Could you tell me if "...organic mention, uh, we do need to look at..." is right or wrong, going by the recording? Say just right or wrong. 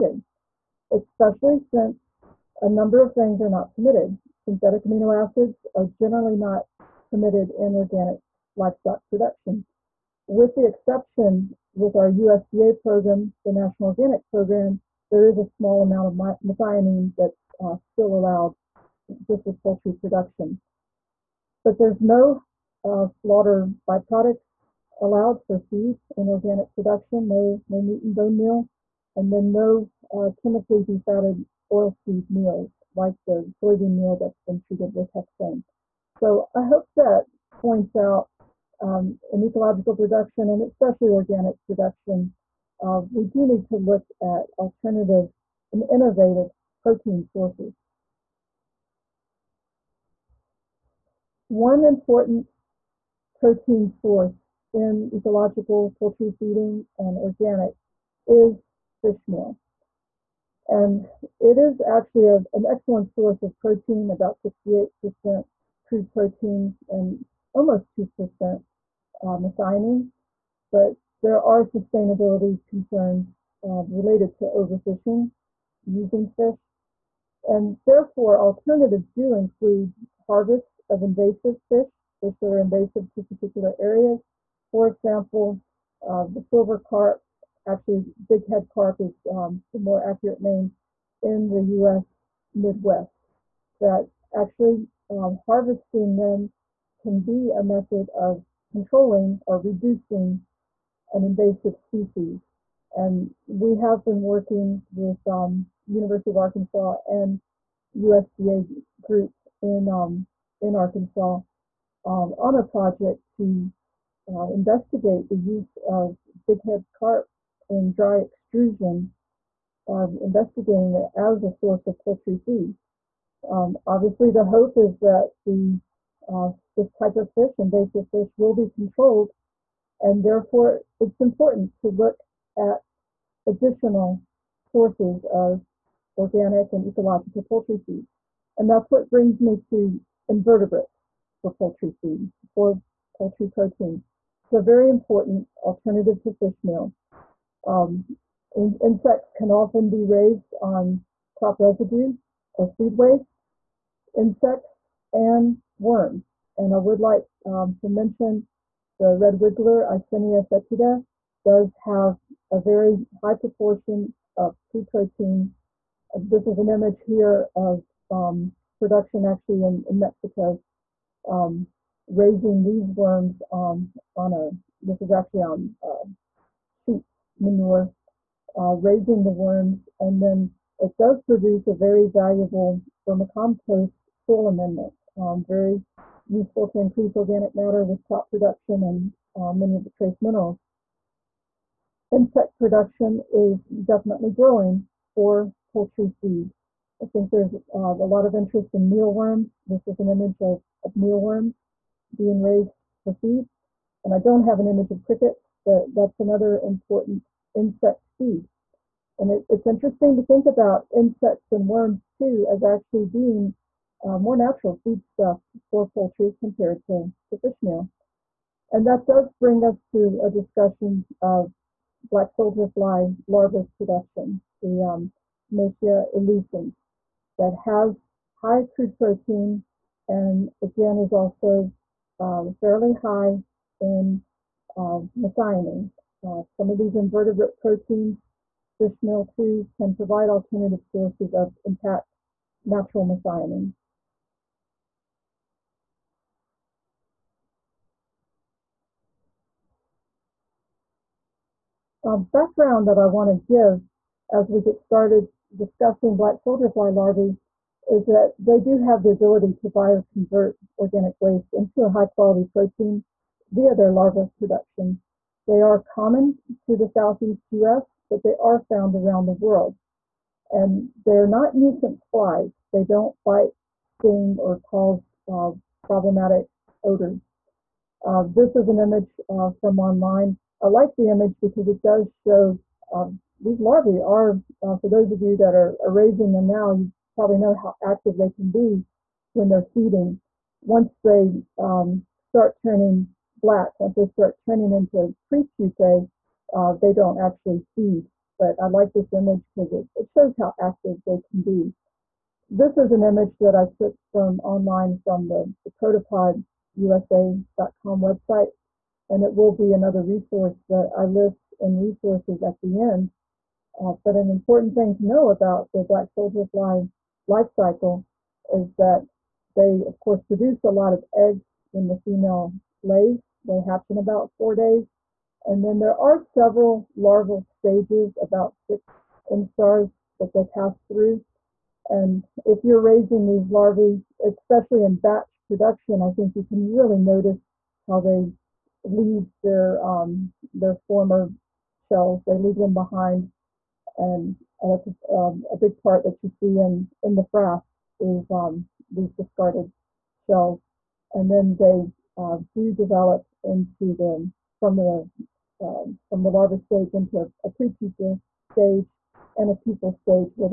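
wrong.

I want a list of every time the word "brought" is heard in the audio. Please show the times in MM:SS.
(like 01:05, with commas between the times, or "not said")
not said.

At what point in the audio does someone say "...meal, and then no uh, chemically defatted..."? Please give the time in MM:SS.
00:28.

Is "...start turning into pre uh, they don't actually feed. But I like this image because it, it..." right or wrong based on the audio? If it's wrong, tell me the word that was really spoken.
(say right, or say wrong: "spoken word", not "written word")
right.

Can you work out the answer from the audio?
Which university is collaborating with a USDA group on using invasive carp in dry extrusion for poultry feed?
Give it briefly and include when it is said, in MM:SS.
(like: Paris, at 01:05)
University of Arkansas, at 01:45.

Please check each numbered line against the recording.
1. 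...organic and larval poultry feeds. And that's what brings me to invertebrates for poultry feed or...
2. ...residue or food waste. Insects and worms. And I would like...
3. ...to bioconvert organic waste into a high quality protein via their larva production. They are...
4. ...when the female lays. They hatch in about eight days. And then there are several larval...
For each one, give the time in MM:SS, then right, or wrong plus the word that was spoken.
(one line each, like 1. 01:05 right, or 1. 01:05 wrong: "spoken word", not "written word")
1. 02:16 wrong: "ecological", not "larval"
2. 02:31 right
3. 04:19 right
4. 05:21 wrong: "four", not "eight".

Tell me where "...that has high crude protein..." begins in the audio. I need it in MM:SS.
03:47.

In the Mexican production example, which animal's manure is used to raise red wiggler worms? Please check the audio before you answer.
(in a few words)
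Sheep manure.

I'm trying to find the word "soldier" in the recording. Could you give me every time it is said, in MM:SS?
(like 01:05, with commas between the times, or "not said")
03:42, 04:16, 05:16.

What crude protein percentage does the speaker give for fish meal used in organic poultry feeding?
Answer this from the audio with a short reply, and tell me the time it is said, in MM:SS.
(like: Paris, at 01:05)
68%, at 01:04.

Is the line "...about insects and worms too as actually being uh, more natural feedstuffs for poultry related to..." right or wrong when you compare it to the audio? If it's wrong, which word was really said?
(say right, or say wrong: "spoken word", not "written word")
wrong: "compared", not "related".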